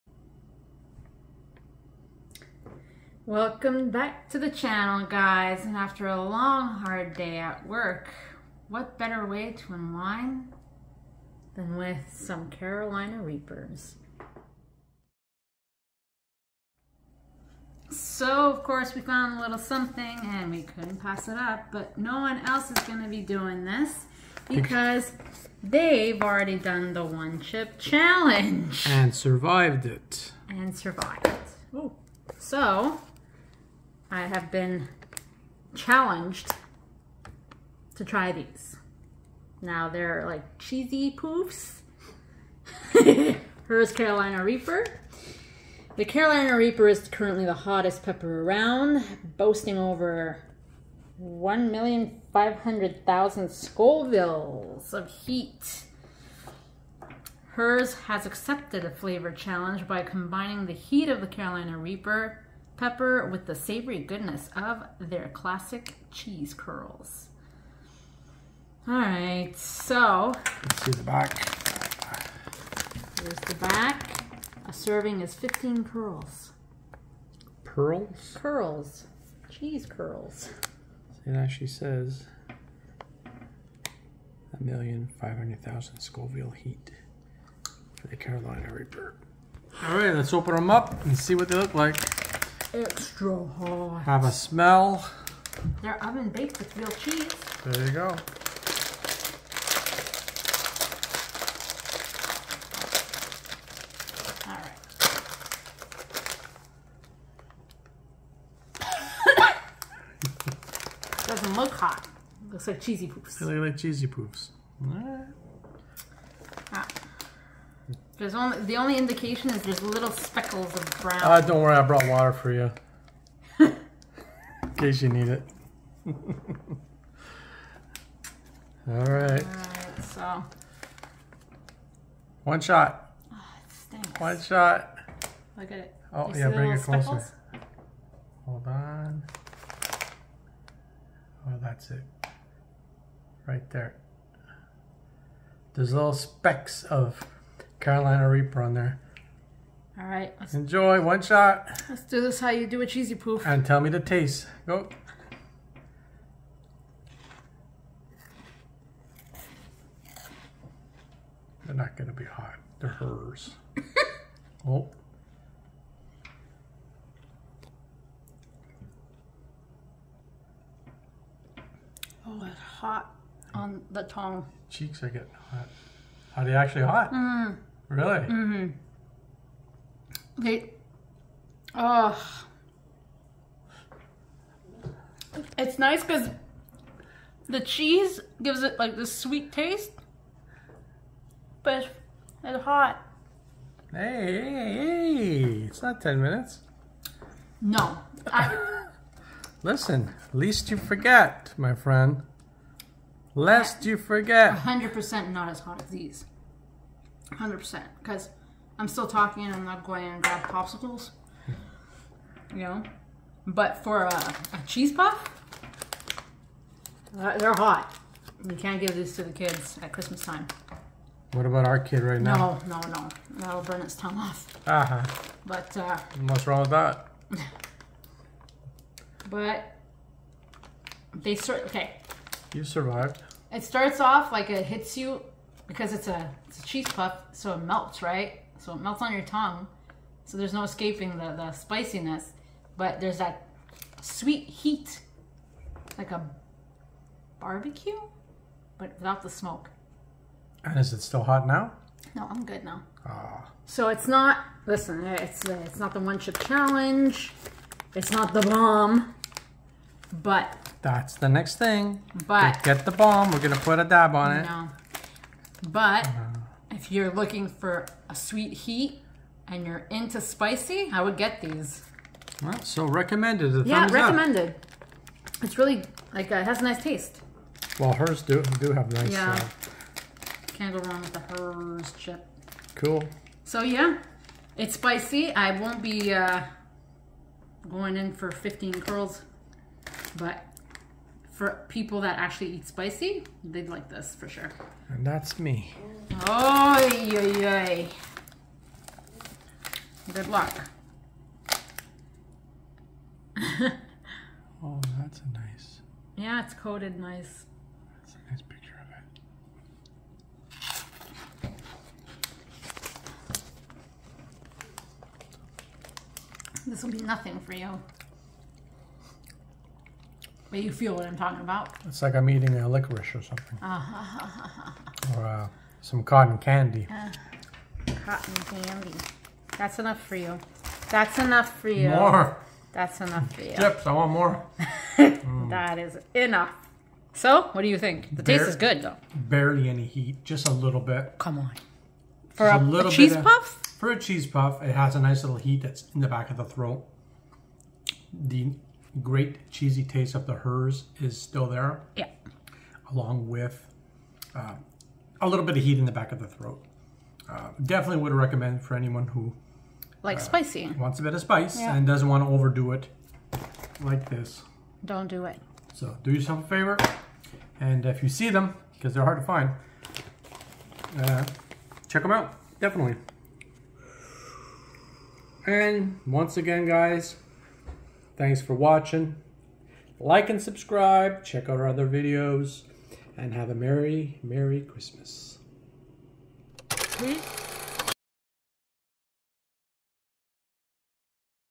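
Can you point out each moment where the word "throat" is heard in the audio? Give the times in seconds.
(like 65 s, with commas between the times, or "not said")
346 s, 356 s.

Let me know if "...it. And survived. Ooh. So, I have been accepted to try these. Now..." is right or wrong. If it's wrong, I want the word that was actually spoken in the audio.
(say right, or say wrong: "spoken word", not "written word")
wrong: "challenged", not "accepted".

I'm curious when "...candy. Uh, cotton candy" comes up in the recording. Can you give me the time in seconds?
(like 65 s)
326 s.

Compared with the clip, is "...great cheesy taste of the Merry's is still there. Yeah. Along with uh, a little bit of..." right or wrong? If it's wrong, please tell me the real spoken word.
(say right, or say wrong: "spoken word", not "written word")
wrong: "Herr", not "Merry".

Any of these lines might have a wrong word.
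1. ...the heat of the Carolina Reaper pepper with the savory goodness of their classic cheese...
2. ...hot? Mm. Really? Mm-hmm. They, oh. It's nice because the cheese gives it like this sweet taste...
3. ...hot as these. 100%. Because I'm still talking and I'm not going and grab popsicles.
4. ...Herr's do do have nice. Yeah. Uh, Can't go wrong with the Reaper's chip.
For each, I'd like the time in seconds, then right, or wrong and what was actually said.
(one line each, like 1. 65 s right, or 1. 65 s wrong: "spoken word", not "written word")
1. 60 s right
2. 176 s right
3. 205 s right
4. 277 s wrong: "Herr", not "Reaper".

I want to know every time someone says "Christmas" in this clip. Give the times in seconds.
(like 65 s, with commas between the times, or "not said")
219 s, 384 s.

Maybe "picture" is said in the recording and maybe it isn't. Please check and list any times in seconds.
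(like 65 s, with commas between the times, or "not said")
308 s.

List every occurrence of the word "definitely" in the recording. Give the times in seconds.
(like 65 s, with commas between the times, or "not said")
357 s, 372 s.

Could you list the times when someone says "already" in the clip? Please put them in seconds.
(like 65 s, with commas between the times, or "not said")
26 s.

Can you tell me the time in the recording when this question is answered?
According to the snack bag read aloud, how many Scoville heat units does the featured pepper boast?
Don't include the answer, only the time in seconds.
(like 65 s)
51 s.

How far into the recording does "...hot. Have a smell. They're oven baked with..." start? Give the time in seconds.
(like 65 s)
93 s.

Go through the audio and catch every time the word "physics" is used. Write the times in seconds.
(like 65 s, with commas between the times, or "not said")
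not said.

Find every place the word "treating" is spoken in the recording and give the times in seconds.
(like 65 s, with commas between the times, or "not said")
not said.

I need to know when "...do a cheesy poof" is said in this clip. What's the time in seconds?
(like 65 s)
152 s.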